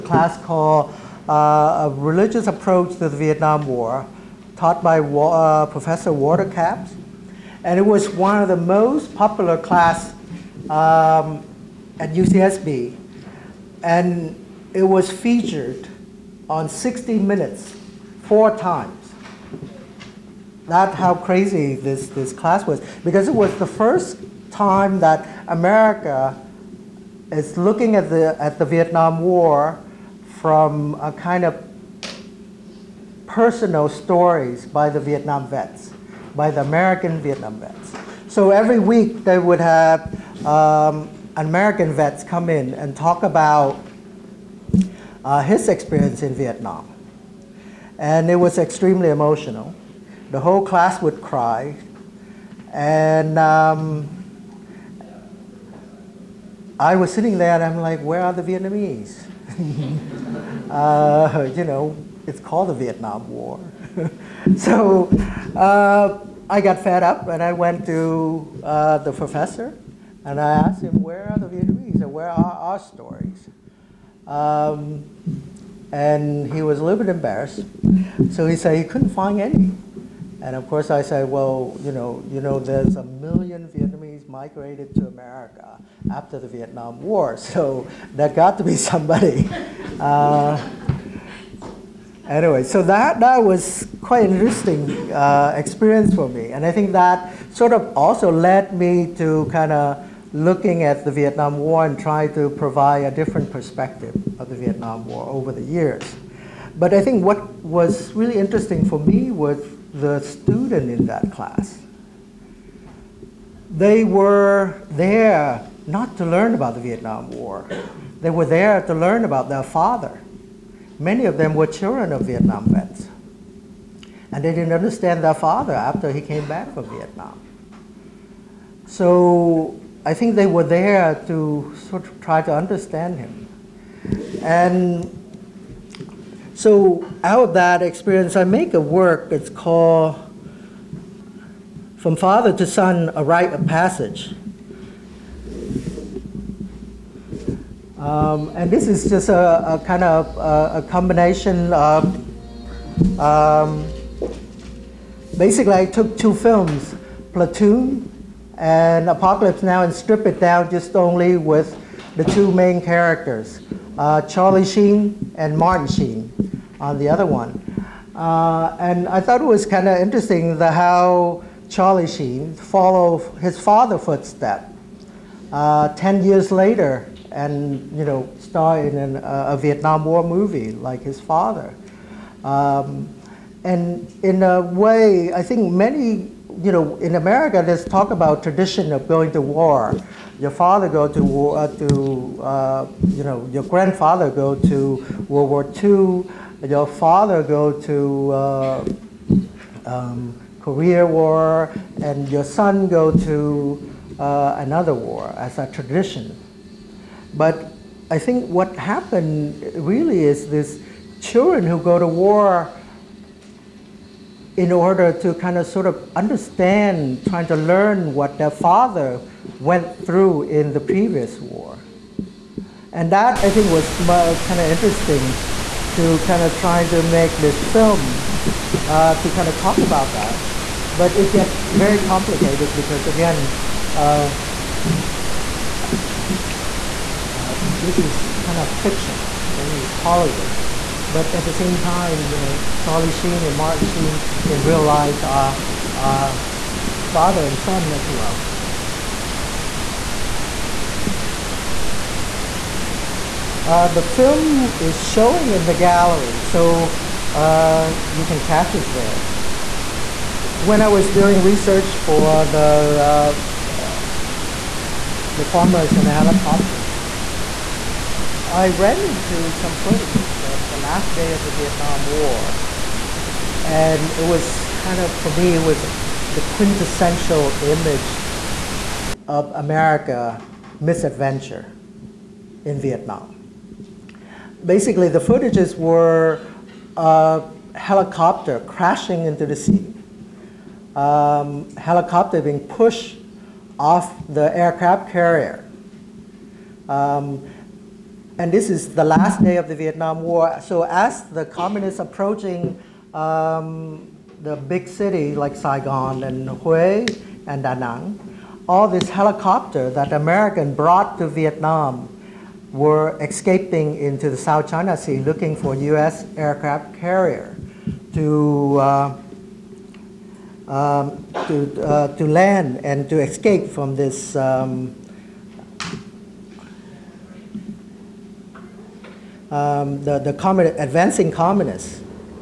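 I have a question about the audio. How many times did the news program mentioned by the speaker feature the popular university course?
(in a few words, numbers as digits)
4.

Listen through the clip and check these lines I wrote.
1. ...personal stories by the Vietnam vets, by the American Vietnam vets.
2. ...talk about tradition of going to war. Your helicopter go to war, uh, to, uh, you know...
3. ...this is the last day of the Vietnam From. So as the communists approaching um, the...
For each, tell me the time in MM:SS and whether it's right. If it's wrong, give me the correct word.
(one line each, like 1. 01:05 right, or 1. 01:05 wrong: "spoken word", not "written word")
1. 00:33 right
2. 03:07 wrong: "father", not "helicopter"
3. 04:58 wrong: "War", not "From".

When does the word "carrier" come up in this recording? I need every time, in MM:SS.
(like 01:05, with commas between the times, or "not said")
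04:55, 05:16.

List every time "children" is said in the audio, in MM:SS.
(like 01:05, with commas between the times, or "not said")
02:01, 03:31.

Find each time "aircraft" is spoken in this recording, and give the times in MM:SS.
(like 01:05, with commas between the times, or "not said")
04:54, 05:16.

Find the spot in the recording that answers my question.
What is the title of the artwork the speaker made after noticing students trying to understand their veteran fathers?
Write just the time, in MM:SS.
02:21.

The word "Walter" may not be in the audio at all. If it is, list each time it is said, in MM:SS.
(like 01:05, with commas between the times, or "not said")
00:06.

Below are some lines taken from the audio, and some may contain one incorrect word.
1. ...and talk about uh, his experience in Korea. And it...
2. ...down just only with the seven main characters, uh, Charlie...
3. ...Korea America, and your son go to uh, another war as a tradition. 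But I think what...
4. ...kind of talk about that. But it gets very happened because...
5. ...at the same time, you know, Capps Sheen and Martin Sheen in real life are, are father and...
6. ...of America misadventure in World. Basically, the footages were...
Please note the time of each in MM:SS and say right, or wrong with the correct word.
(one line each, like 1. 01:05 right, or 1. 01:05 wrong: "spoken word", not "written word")
1. 00:42 wrong: "Vietnam", not "Korea"
2. 02:40 wrong: "two", not "seven"
3. 03:20 wrong: "War", not "America"
4. 03:49 wrong: "complicated", not "happened"
5. 04:01 wrong: "Charlie", not "Capps"
6. 04:39 wrong: "Vietnam", not "World".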